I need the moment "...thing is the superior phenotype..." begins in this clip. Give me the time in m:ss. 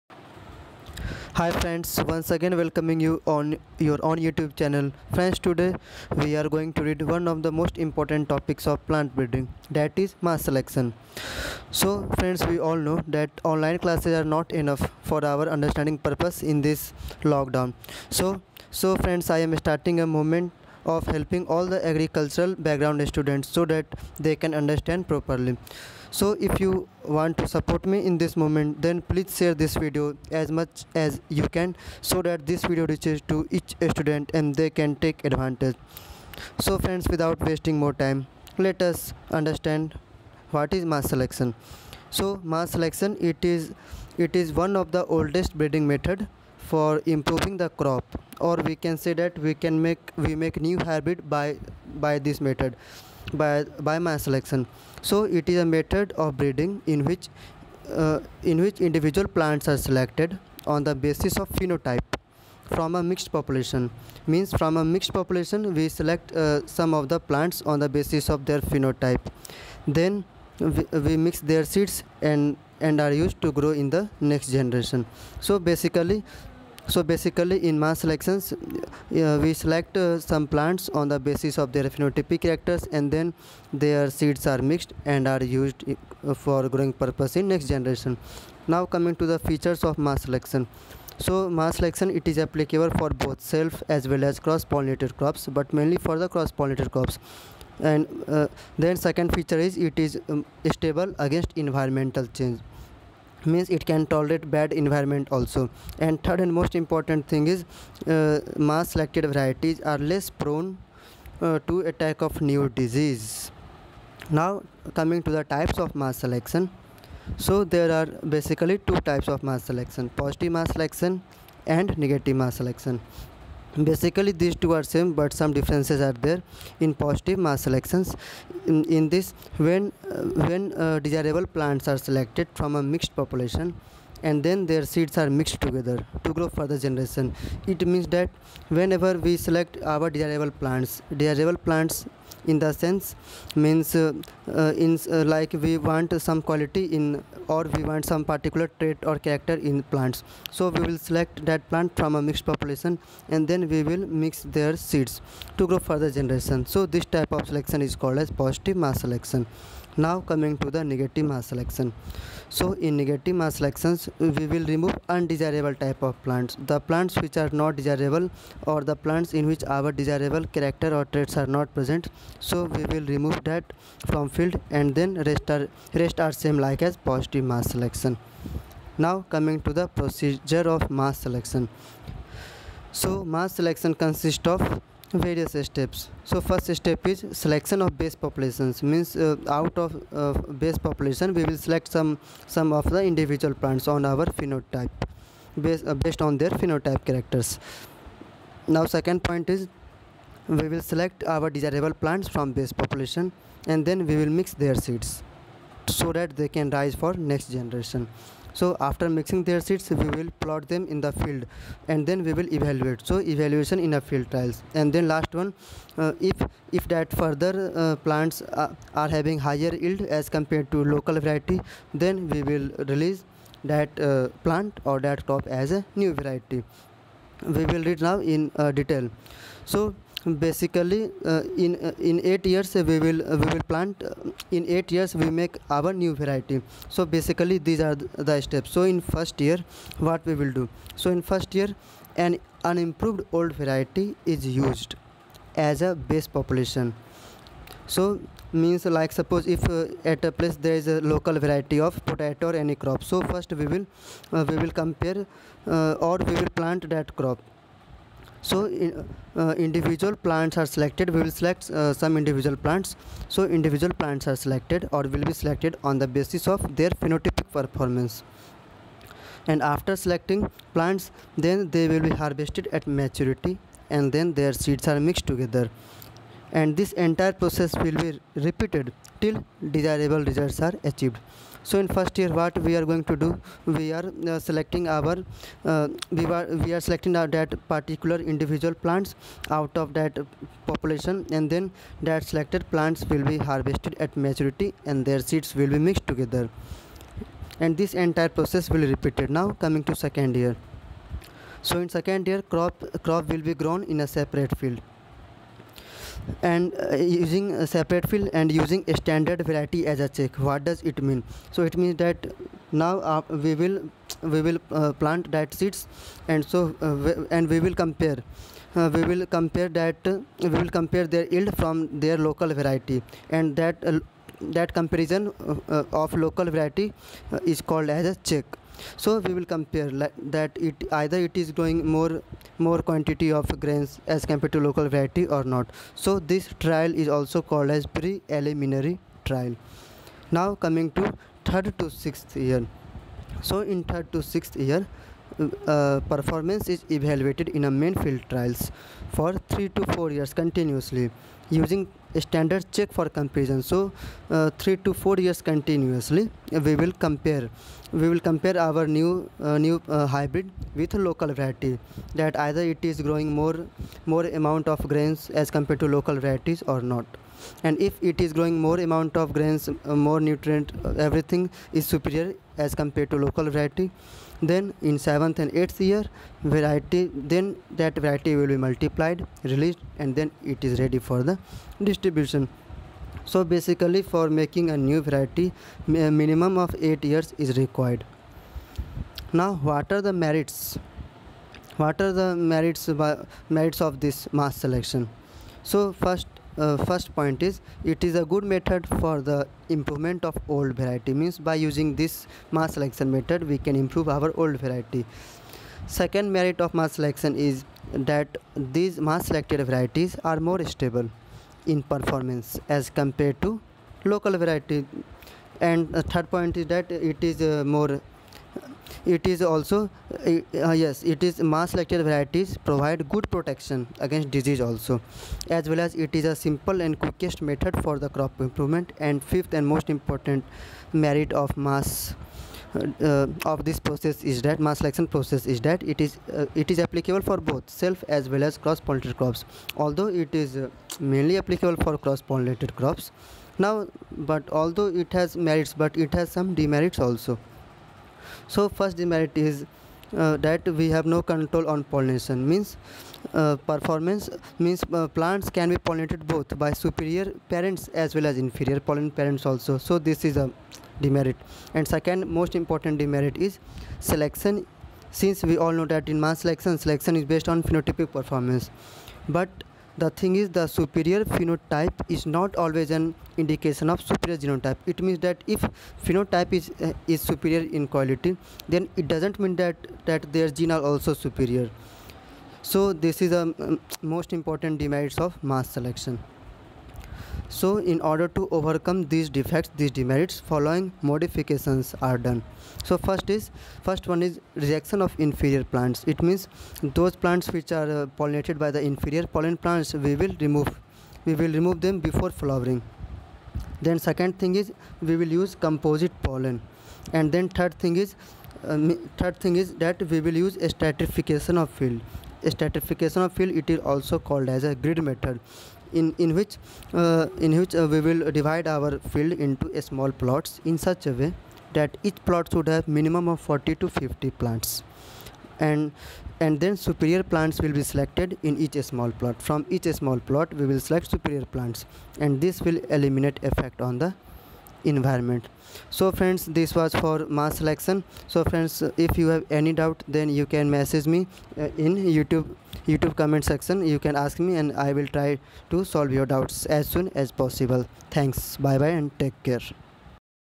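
7:50.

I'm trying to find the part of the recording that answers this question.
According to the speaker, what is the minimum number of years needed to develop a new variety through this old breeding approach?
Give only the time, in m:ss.
6:26.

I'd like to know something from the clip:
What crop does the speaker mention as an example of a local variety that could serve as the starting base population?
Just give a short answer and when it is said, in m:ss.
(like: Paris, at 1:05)
Potato, at 4:12.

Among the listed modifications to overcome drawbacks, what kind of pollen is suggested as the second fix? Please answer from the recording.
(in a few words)
Composite pollen.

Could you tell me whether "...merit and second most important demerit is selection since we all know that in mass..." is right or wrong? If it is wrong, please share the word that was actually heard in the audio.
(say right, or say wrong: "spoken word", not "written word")
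wrong: "demerit", not "merit".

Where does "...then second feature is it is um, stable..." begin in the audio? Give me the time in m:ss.
1:38.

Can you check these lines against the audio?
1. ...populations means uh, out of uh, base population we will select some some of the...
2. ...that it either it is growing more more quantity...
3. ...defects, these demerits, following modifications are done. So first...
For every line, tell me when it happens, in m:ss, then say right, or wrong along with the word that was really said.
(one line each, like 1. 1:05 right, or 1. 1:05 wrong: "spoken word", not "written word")
1. 3:08 right
2. 5:30 right
3. 8:09 right.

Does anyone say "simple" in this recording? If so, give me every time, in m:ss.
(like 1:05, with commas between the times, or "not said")
7:06.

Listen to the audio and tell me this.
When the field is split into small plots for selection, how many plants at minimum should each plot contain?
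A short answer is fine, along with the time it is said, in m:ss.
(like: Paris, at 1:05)
40 to 50, at 8:43.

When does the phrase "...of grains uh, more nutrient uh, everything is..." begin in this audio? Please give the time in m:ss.
6:09.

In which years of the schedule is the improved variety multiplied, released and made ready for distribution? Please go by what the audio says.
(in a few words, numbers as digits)
7th and 8th year.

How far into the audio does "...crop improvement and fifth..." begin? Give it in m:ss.
7:08.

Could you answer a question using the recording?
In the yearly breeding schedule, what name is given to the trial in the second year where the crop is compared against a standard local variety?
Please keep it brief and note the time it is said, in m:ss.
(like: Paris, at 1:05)
Preliminary trial, at 5:37.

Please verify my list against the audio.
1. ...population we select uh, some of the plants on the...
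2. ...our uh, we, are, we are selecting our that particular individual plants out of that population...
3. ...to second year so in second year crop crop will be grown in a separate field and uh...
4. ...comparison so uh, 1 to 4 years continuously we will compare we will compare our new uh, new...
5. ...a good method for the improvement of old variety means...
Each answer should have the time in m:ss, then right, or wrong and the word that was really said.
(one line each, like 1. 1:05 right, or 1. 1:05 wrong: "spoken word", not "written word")
1. 1:05 right
2. 4:44 right
3. 4:59 right
4. 5:53 wrong: "3", not "1"
5. 6:38 right.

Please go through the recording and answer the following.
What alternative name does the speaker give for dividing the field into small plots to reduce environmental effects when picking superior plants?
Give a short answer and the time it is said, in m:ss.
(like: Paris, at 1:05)
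Grid method, at 8:34.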